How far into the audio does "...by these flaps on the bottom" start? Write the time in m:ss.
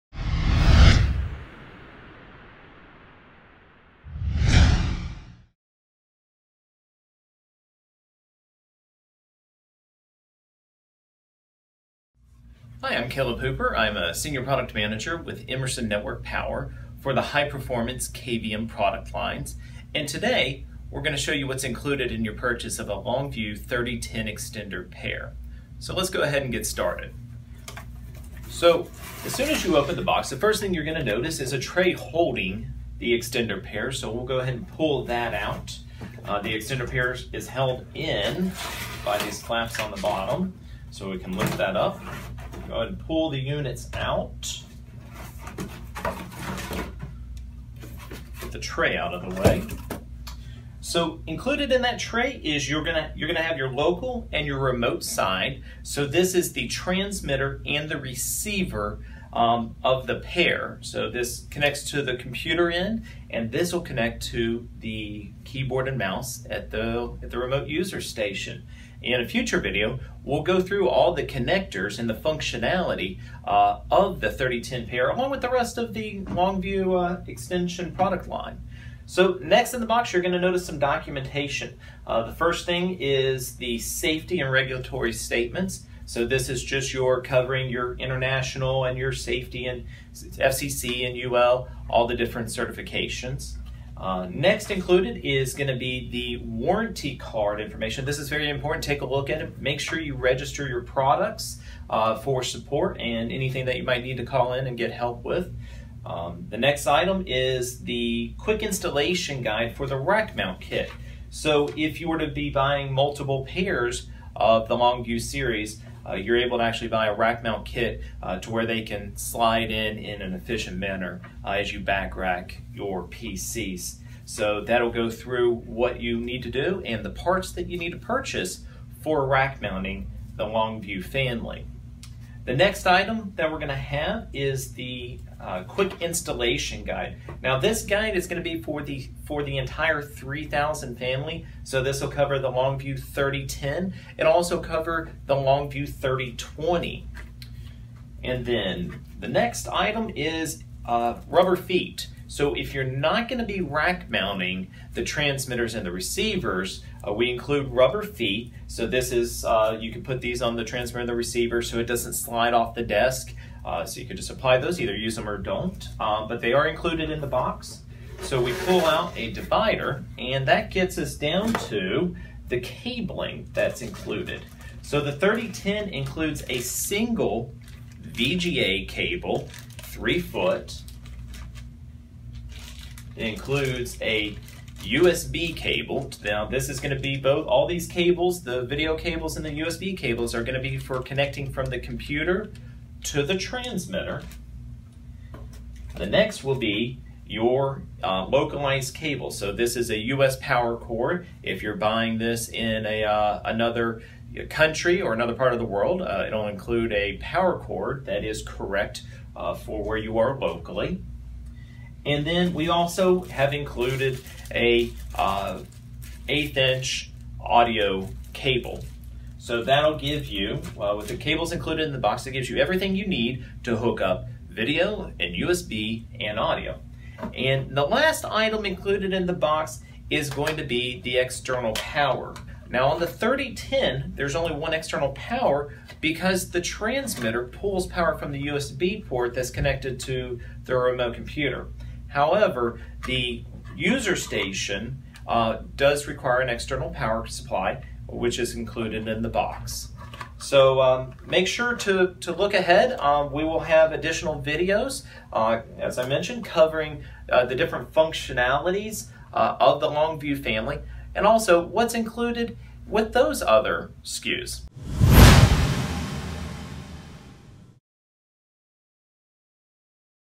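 0:39.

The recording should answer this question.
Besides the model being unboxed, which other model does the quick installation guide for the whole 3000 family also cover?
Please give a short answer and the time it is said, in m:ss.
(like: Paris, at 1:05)
Longview 3020, at 2:25.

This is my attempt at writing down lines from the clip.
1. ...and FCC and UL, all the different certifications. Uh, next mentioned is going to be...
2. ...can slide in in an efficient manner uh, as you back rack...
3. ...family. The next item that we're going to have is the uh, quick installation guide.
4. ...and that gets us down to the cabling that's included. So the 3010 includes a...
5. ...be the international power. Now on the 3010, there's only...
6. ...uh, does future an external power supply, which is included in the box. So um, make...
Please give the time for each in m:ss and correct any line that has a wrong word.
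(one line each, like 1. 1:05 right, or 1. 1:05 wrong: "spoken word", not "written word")
1. 1:29 wrong: "included", not "mentioned"
2. 1:58 right
3. 2:11 right
4. 2:50 right
5. 3:50 wrong: "external", not "international"
6. 4:05 wrong: "require", not "future".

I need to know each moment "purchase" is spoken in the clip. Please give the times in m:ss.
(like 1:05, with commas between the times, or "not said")
0:22, 2:07.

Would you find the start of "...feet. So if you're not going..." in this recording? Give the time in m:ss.
2:31.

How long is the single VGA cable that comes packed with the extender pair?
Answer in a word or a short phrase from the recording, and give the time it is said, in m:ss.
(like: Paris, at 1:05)
3 feet, at 2:59.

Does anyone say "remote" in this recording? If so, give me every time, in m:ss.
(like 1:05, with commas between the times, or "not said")
0:54, 1:07, 4:00.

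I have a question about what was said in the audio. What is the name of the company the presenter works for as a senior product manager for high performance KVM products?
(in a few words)
Emerson Network Power.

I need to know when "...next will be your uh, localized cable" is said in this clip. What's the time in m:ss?
3:16.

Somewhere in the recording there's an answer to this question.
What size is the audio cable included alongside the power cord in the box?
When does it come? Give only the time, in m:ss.
3:36.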